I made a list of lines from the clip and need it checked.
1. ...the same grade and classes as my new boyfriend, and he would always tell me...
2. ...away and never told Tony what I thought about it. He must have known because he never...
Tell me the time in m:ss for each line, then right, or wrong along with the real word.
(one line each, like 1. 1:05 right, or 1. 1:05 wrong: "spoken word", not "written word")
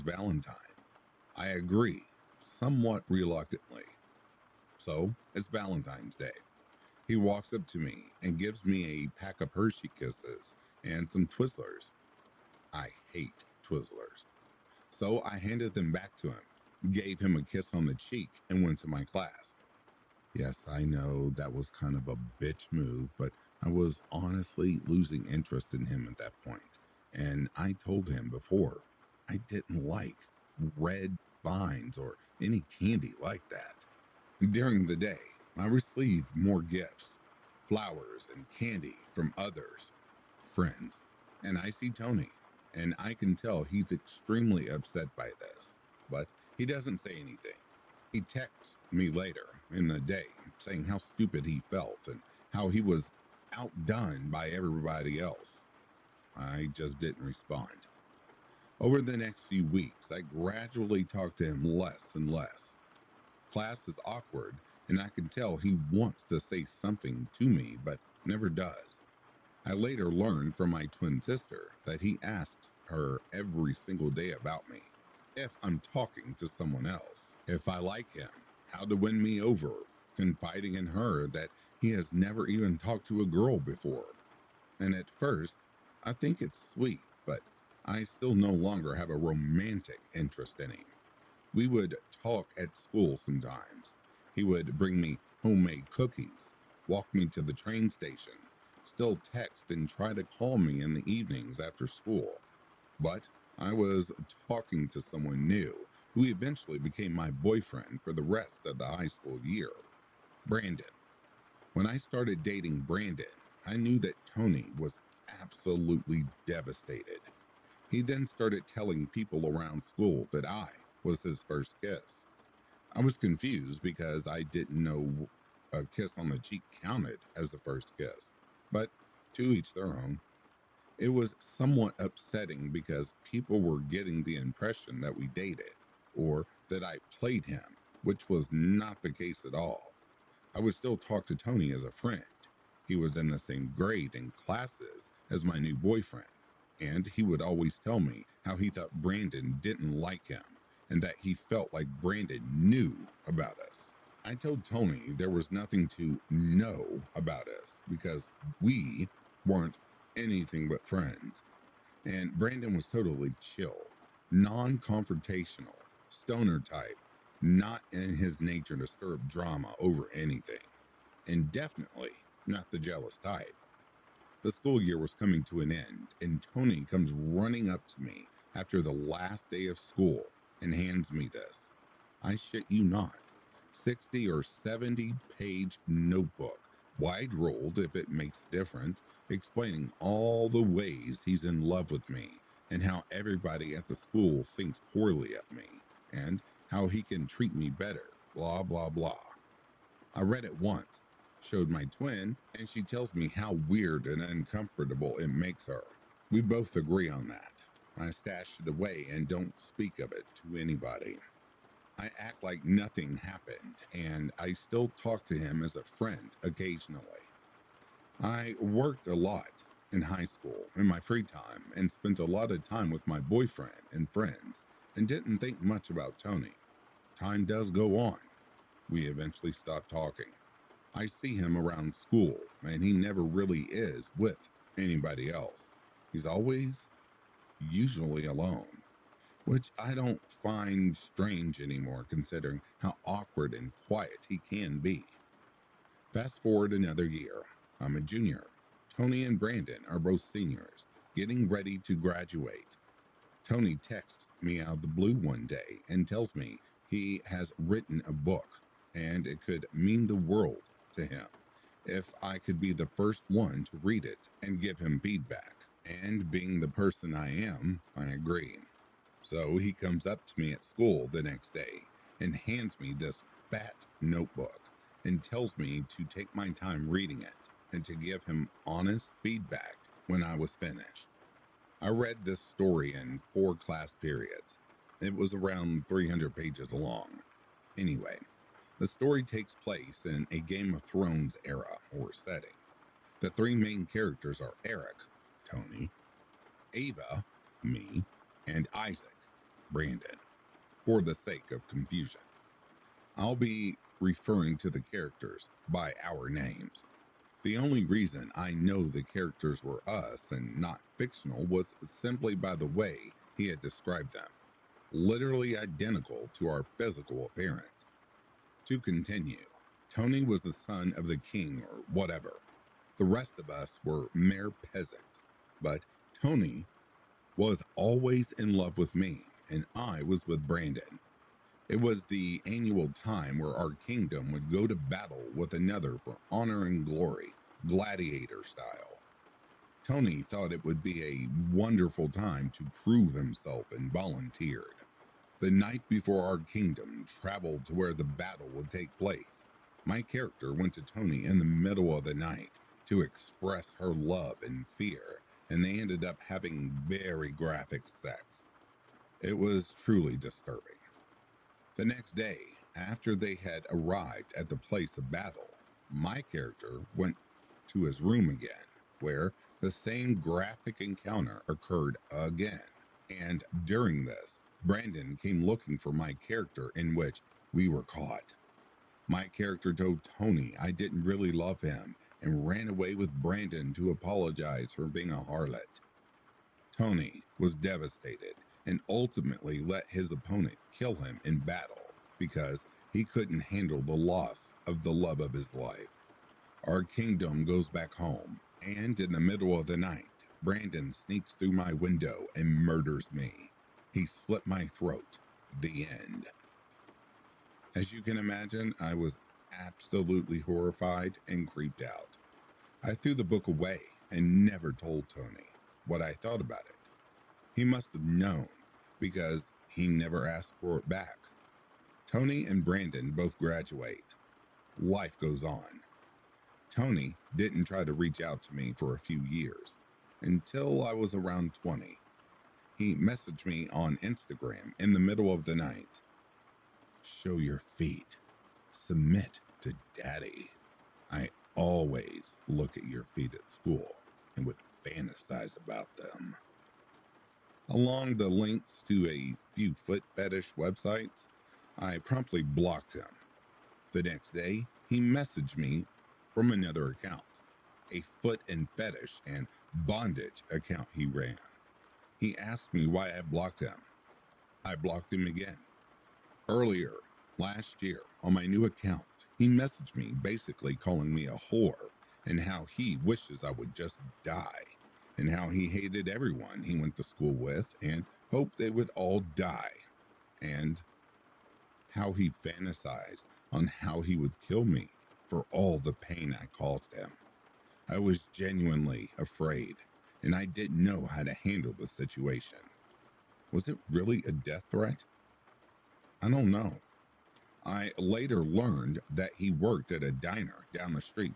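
1. 2:23 right
2. 6:53 right.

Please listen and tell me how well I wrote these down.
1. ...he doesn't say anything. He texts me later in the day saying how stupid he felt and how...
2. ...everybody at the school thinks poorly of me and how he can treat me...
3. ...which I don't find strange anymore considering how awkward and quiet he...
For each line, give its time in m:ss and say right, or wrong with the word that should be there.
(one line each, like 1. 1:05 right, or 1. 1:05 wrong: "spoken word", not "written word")
1. 0:46 right
2. 3:13 right
3. 3:59 right.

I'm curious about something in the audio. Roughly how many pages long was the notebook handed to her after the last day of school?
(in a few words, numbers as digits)
60 or 70.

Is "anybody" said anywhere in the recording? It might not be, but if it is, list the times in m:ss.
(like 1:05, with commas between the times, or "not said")
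3:30, 3:54.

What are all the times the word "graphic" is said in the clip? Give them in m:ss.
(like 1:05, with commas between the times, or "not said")
5:57, 6:10.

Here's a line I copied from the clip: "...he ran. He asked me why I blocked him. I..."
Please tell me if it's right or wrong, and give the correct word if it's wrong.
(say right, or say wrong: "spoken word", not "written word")
right.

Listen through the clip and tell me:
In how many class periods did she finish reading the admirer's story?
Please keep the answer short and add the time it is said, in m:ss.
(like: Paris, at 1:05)
4, at 4:43.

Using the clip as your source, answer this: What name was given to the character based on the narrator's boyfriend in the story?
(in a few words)
Isaac.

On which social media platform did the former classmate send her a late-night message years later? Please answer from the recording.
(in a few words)
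Instagram.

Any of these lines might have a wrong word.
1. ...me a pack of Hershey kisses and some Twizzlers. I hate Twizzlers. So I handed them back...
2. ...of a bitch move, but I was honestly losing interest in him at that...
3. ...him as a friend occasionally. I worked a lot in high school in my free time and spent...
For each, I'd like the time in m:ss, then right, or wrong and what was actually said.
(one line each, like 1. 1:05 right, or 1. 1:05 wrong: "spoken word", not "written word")
1. 0:08 right
2. 0:21 right
3. 3:35 right.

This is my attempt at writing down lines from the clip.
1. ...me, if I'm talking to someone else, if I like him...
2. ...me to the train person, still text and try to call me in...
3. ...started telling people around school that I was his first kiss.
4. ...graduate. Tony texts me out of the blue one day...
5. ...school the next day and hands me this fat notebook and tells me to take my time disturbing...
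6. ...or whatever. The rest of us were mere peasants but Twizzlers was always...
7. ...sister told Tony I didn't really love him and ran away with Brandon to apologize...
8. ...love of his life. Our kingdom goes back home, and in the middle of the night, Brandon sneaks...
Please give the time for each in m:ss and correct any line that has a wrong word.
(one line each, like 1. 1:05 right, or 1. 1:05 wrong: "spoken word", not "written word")
1. 1:14 right
2. 1:37 wrong: "station", not "person"
3. 1:58 right
4. 4:11 right
5. 4:30 wrong: "reading", not "disturbing"
6. 5:21 wrong: "Tony", not "Twizzlers"
7. 6:19 wrong: "character", not "sister"
8. 6:34 right.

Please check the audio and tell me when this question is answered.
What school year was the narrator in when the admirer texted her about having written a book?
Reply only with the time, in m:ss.
4:08.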